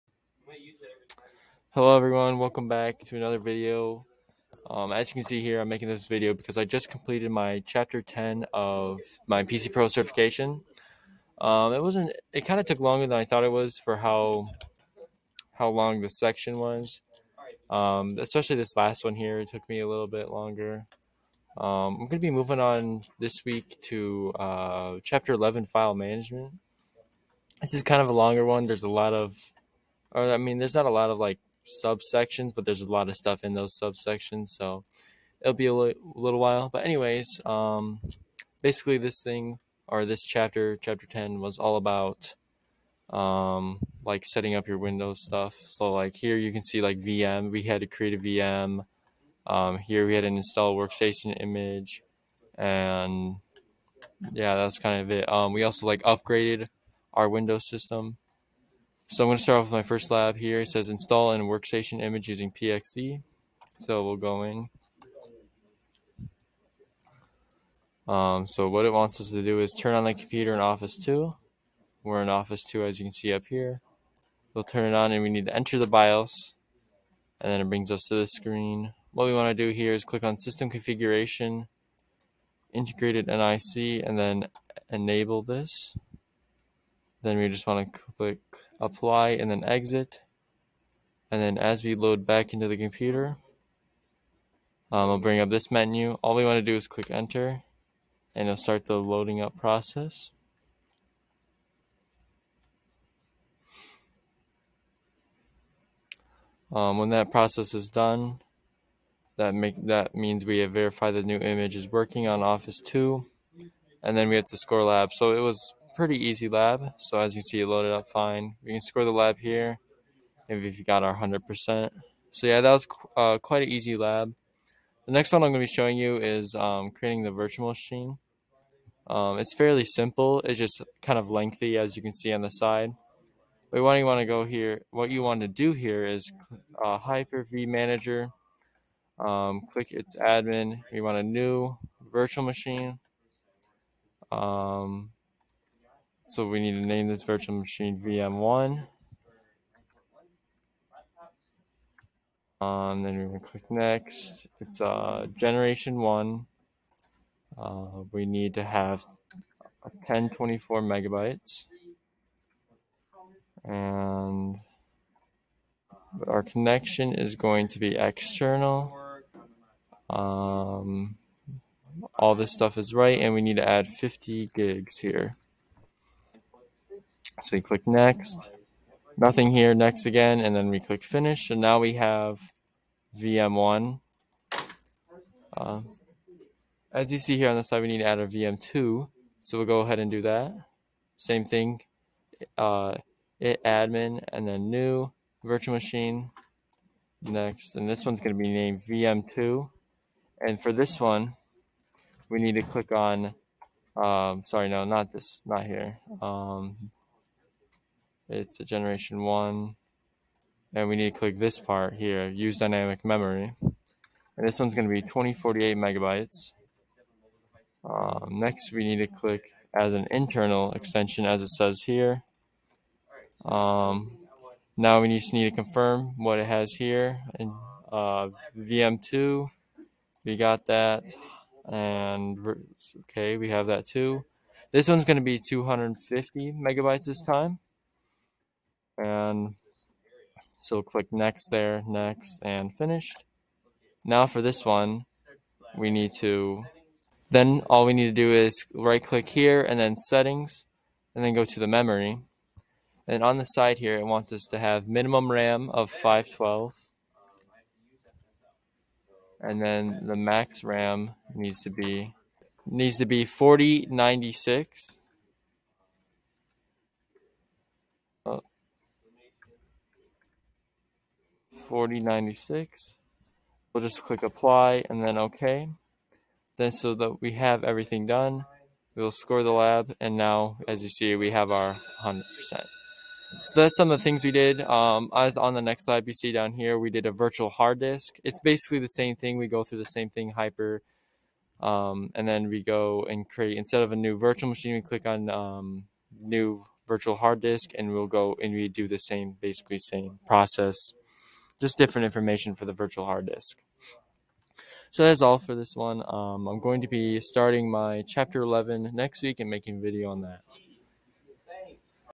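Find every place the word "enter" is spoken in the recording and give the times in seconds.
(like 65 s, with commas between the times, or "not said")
75 s, 97 s.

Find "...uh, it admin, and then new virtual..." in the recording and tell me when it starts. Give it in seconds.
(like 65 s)
192 s.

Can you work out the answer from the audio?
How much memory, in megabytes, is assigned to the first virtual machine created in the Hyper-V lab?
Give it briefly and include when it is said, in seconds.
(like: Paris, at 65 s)
1024, at 160 s.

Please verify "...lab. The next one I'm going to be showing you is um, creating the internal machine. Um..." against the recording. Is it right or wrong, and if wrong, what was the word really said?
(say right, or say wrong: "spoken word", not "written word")
wrong: "virtual", not "internal".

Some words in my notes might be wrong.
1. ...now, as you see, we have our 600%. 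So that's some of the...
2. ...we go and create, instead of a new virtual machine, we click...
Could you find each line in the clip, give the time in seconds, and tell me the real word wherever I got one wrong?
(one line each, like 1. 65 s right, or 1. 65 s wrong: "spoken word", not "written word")
1. 280 s wrong: "100", not "600"
2. 292 s right.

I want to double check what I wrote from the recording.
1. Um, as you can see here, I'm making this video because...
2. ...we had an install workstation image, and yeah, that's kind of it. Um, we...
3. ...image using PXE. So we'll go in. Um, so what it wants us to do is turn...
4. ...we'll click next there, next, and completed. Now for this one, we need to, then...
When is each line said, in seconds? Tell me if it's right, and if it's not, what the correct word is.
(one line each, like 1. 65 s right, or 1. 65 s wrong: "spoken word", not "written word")
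1. 4 s right
2. 50 s right
3. 62 s right
4. 240 s wrong: "finished", not "completed".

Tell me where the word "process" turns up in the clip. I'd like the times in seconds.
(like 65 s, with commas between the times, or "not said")
99 s, 107 s, 300 s.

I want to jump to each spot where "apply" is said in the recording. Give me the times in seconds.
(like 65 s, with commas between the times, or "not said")
88 s, 274 s.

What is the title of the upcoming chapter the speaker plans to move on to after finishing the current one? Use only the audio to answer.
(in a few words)
File management.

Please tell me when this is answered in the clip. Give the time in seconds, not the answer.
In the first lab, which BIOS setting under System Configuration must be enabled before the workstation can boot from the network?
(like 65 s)
82 s.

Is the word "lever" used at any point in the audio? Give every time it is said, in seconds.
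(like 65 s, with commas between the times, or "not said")
not said.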